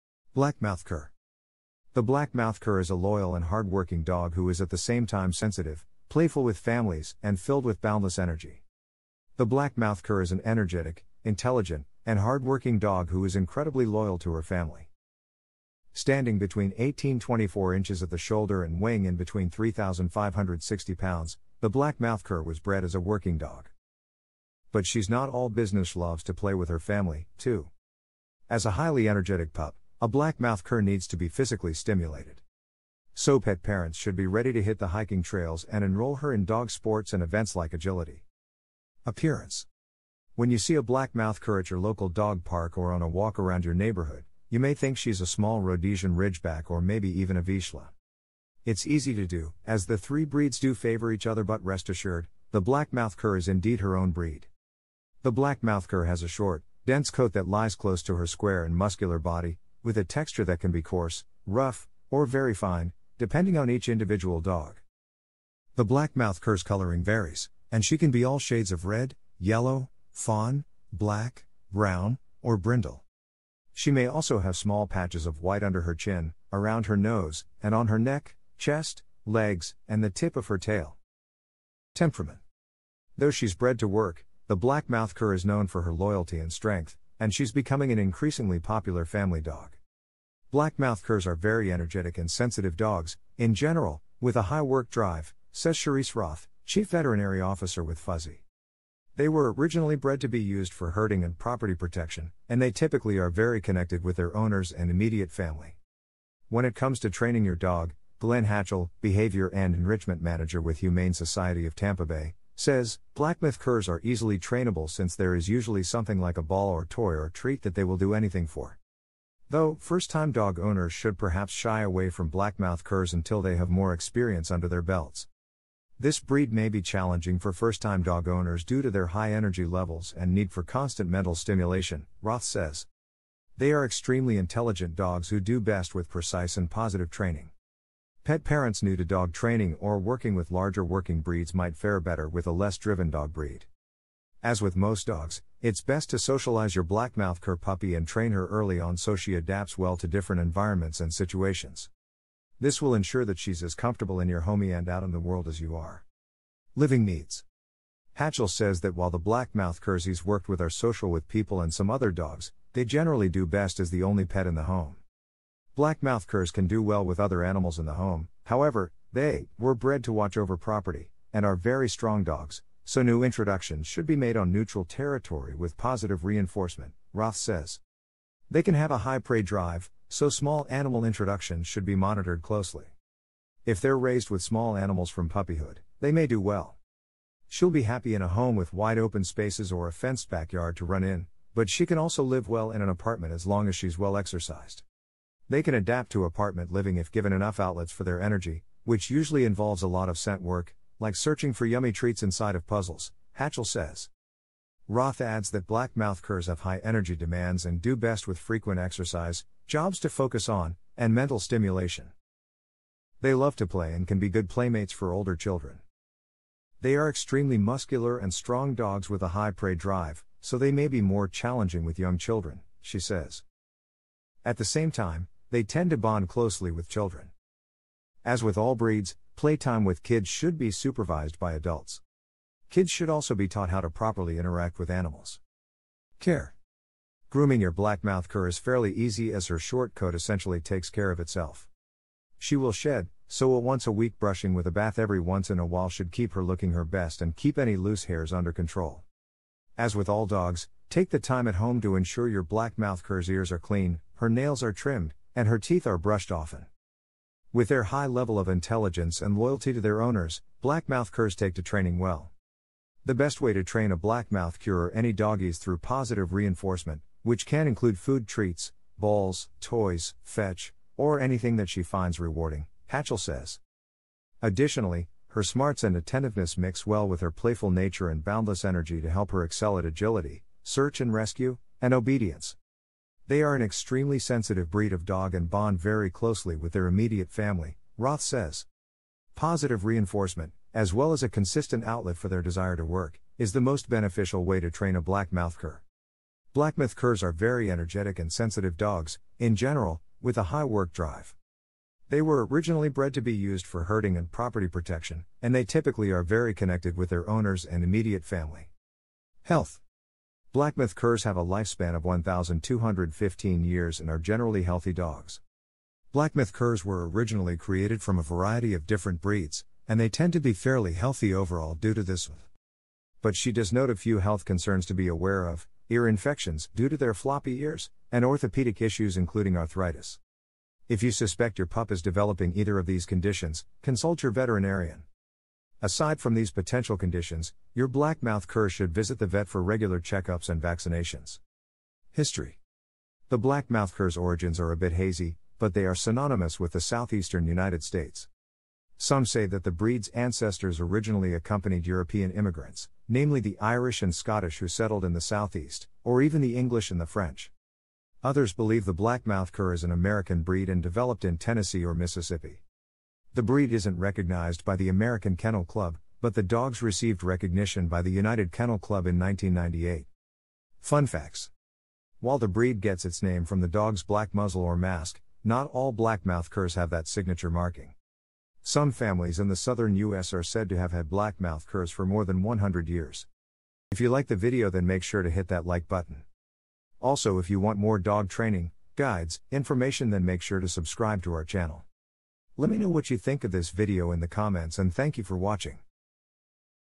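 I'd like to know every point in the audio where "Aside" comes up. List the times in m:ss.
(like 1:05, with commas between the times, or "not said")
5:35.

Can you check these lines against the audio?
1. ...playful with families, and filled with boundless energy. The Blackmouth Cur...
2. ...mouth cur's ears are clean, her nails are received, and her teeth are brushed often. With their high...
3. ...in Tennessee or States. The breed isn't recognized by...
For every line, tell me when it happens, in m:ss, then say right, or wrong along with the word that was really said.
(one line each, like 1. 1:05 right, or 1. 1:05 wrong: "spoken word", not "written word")
1. 0:06 right
2. 4:12 wrong: "trimmed", not "received"
3. 6:01 wrong: "Mississippi", not "States".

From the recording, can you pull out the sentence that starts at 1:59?
Though, first time dog owners should perhaps shy away from blackmouth curs until they have more experience under their belts.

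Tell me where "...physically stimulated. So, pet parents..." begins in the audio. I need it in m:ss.
0:31.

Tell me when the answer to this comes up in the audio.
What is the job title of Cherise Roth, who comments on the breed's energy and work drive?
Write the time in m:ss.
1:36.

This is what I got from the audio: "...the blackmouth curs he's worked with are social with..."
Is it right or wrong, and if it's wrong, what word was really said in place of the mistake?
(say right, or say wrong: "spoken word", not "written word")
right.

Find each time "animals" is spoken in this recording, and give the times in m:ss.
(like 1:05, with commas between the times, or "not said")
2:47, 3:00, 3:04, 3:54.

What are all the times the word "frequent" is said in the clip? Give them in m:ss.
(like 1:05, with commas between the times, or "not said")
3:28.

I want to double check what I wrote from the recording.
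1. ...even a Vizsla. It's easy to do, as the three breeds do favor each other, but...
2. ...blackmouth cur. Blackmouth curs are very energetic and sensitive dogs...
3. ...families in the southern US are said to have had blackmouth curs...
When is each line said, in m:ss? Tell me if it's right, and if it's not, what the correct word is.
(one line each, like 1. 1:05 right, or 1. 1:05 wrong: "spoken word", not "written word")
1. 0:47 right
2. 4:55 right
3. 6:18 right.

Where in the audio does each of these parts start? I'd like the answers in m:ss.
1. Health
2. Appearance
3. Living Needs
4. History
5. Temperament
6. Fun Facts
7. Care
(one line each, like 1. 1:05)
1. 5:09
2. 0:39
3. 2:37
4. 5:42
5. 1:22
6. 6:11
7. 3:56.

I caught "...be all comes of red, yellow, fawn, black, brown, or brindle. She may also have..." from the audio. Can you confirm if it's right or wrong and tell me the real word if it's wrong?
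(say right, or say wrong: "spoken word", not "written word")
wrong: "shades", not "comes".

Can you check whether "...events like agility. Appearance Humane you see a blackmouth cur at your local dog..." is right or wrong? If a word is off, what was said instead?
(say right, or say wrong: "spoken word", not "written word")
wrong: "When", not "Humane".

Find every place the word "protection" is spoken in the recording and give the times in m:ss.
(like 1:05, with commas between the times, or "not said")
1:41, 5:04.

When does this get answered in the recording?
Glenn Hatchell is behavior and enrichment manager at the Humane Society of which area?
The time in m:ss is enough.
1:51.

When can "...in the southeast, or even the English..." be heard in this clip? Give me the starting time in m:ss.
5:55.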